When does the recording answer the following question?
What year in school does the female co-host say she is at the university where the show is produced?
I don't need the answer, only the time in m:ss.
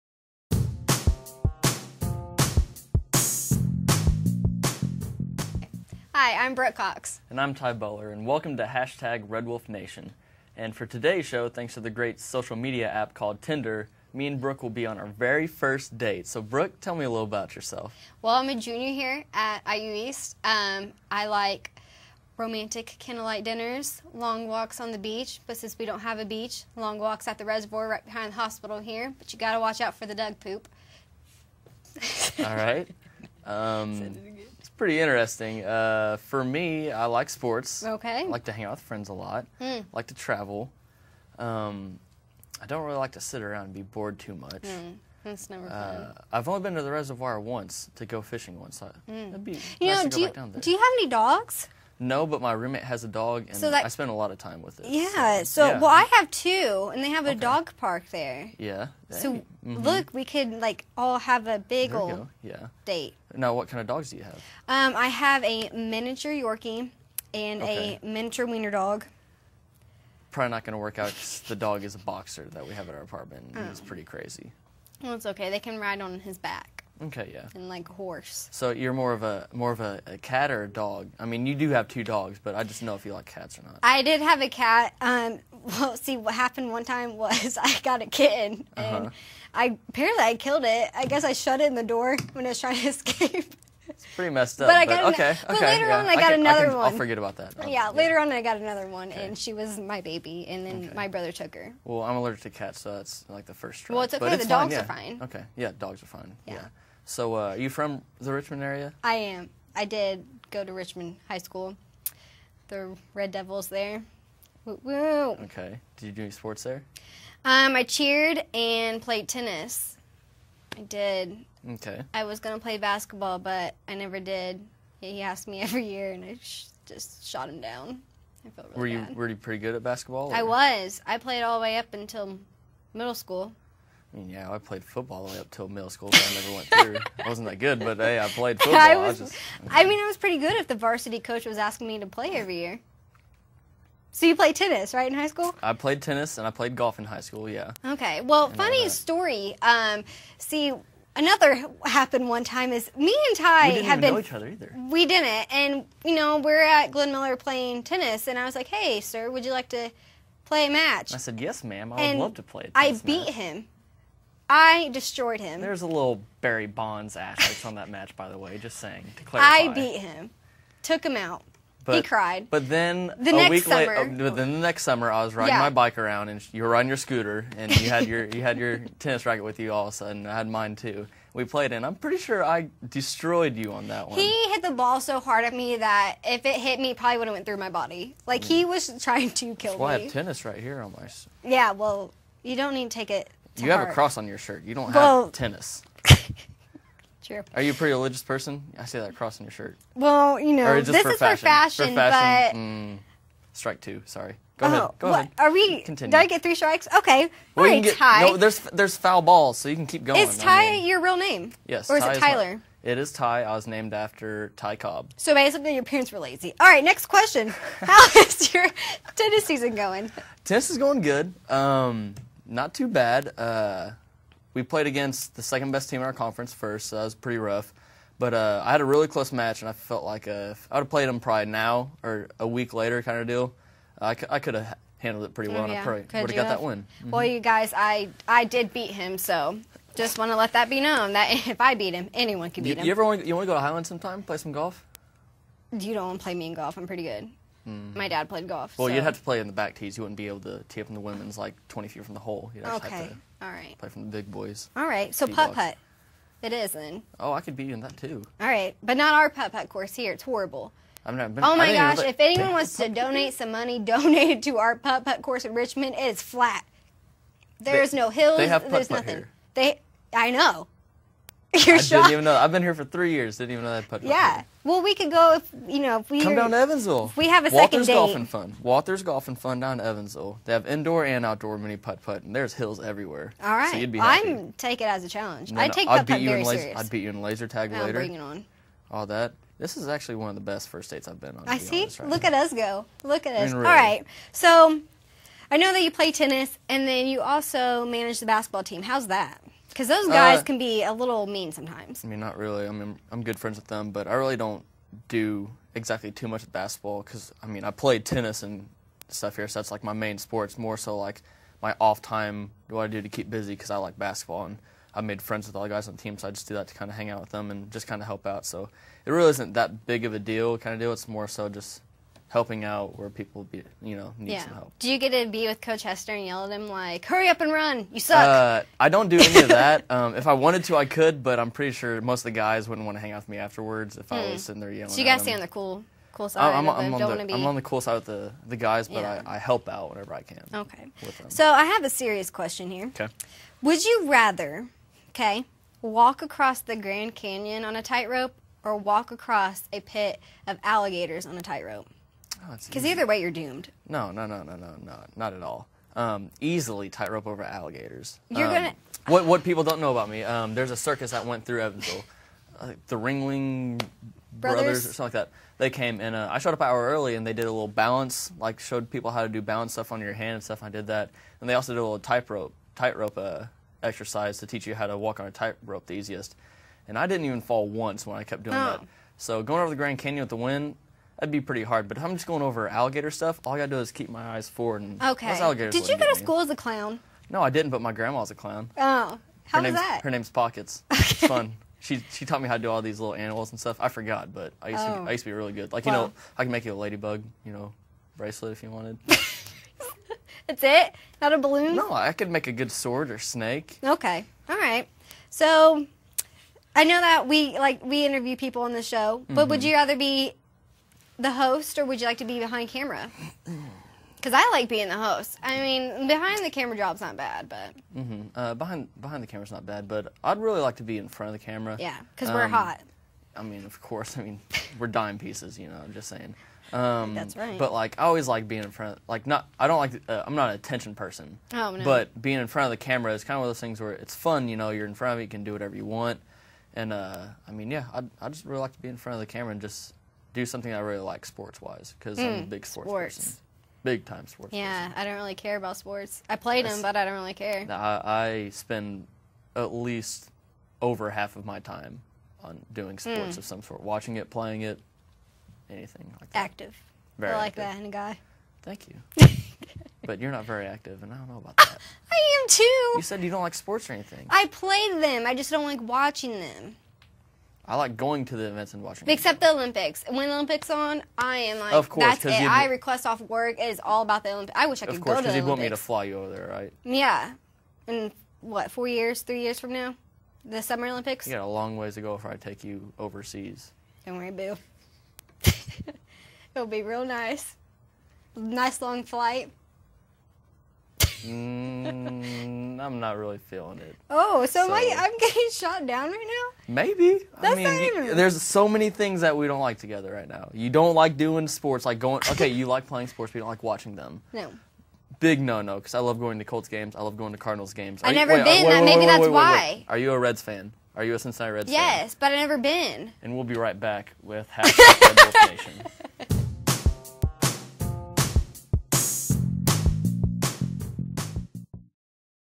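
0:18.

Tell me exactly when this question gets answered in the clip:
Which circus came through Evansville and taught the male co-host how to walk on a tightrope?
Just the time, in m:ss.
6:02.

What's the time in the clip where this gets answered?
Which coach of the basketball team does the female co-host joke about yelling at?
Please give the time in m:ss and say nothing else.
5:25.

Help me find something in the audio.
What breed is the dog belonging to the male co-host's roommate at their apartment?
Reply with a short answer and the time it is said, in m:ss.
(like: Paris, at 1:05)
Boxer, at 1:12.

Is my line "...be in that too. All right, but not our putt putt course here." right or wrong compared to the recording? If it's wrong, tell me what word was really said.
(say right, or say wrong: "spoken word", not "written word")
right.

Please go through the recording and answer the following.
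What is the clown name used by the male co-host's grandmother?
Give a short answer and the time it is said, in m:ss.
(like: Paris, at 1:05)
Pockets, at 6:30.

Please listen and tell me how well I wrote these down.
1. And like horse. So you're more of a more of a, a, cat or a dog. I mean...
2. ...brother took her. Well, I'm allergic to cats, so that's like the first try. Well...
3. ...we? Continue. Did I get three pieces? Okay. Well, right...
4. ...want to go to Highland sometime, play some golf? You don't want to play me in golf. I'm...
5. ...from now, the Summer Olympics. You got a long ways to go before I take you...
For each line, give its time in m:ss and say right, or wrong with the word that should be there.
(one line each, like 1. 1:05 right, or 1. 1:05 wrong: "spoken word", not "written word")
1. 1:17 right
2. 1:41 right
3. 3:25 wrong: "strikes", not "pieces"
4. 4:03 right
5. 7:59 right.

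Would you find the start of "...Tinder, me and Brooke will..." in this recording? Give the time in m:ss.
0:13.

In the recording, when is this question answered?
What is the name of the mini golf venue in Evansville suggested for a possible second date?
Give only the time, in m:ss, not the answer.
4:38.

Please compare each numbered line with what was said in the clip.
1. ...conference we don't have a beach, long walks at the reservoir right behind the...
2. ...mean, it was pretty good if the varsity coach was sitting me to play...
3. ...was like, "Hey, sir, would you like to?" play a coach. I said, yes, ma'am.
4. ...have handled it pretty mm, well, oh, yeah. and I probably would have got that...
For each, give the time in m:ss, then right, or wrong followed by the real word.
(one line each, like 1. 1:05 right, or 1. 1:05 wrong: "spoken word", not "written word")
1. 0:25 wrong: "since", not "conference"
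2. 2:19 wrong: "asking", not "sitting"
3. 2:38 wrong: "match", not "coach"
4. 3:54 right.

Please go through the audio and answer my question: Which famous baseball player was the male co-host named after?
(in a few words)
Ty Cobb.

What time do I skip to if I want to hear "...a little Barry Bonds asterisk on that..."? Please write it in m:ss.
2:45.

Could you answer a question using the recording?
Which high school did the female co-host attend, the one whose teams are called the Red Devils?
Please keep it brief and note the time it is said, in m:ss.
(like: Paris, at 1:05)
Richmond High School, at 1:50.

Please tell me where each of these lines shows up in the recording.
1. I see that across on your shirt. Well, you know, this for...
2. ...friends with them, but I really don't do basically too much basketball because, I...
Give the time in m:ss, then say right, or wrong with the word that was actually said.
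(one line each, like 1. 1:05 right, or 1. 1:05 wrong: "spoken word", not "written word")
1. 3:18 wrong: "cross", not "across"
2. 5:03 wrong: "exactly", not "basically".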